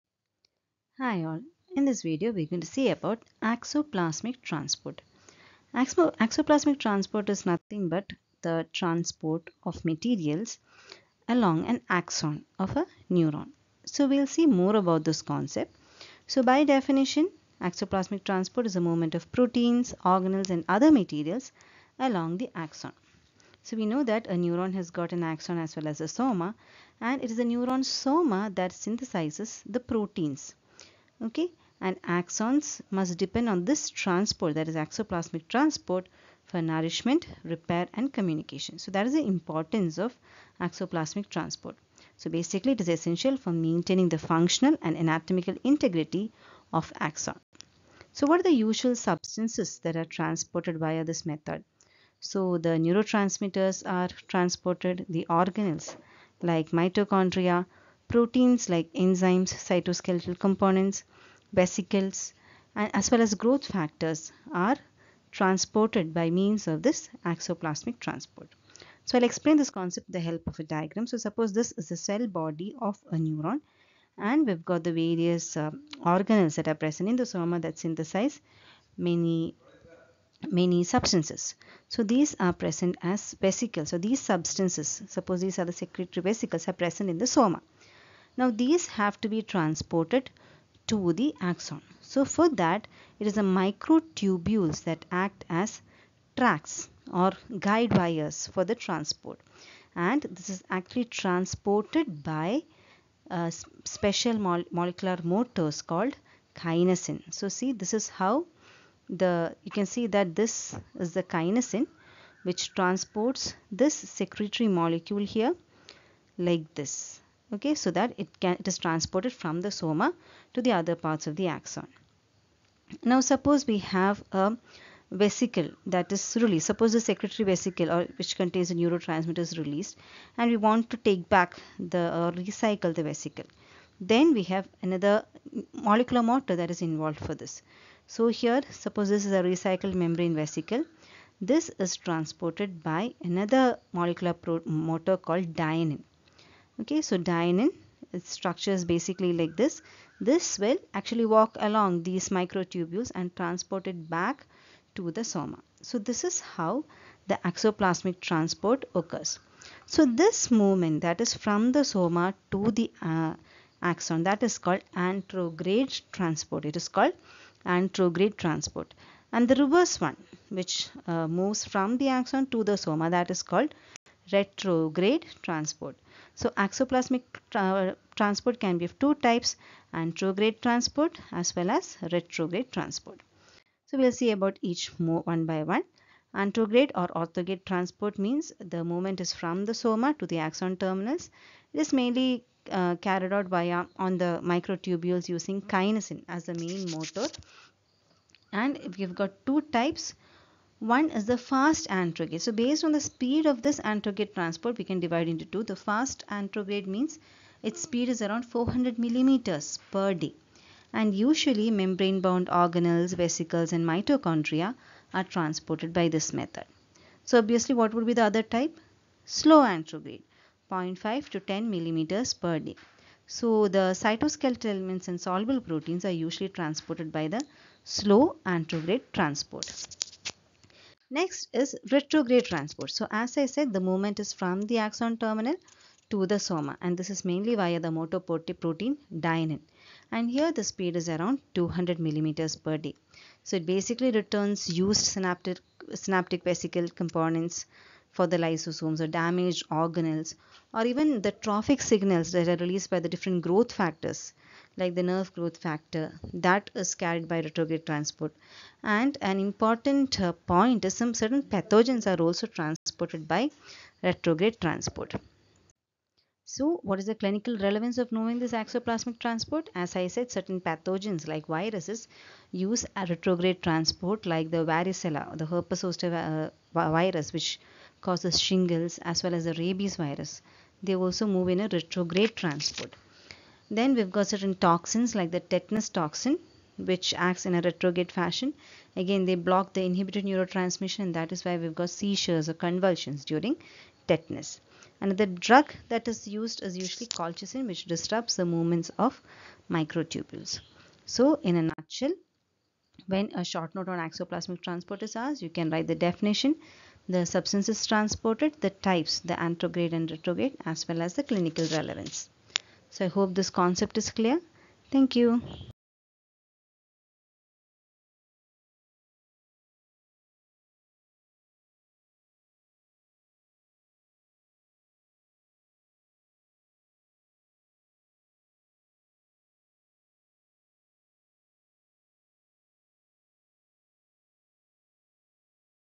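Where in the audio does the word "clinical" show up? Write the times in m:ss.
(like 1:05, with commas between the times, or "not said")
4:27, 5:11.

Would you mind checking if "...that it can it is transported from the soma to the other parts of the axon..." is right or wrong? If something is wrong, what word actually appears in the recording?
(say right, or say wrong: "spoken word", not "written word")
right.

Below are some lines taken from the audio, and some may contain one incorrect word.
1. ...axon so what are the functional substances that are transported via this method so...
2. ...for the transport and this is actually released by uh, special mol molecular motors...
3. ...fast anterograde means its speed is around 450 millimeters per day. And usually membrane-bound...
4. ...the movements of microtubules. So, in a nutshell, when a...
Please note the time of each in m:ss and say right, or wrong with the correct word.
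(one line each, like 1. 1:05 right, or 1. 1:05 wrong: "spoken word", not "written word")
1. 0:46 wrong: "usual", not "functional"
2. 1:38 wrong: "transported", not "released"
3. 3:25 wrong: "400", not "450"
4. 4:58 right.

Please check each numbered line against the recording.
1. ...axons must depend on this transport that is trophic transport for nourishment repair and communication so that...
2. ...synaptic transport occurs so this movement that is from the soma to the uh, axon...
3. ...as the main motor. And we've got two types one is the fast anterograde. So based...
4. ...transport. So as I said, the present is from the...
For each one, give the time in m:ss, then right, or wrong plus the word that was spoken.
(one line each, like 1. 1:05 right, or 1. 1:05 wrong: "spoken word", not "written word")
1. 0:32 wrong: "axoplasmic", not "trophic"
2. 2:37 wrong: "axoplasmic", not "synaptic"
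3. 3:16 right
4. 3:52 wrong: "movement", not "present".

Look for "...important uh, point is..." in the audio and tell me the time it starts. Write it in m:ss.
4:19.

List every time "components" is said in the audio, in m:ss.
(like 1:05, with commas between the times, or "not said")
1:00, 4:06.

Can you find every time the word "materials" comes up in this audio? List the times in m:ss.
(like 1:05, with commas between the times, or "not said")
0:09, 0:20.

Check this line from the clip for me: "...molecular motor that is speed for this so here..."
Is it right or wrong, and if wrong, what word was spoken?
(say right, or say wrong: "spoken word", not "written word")
wrong: "involved", not "speed".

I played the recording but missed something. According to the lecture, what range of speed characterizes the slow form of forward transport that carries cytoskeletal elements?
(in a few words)
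0.5 to 10 mm/day.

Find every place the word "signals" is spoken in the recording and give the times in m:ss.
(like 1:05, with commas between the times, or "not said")
4:11.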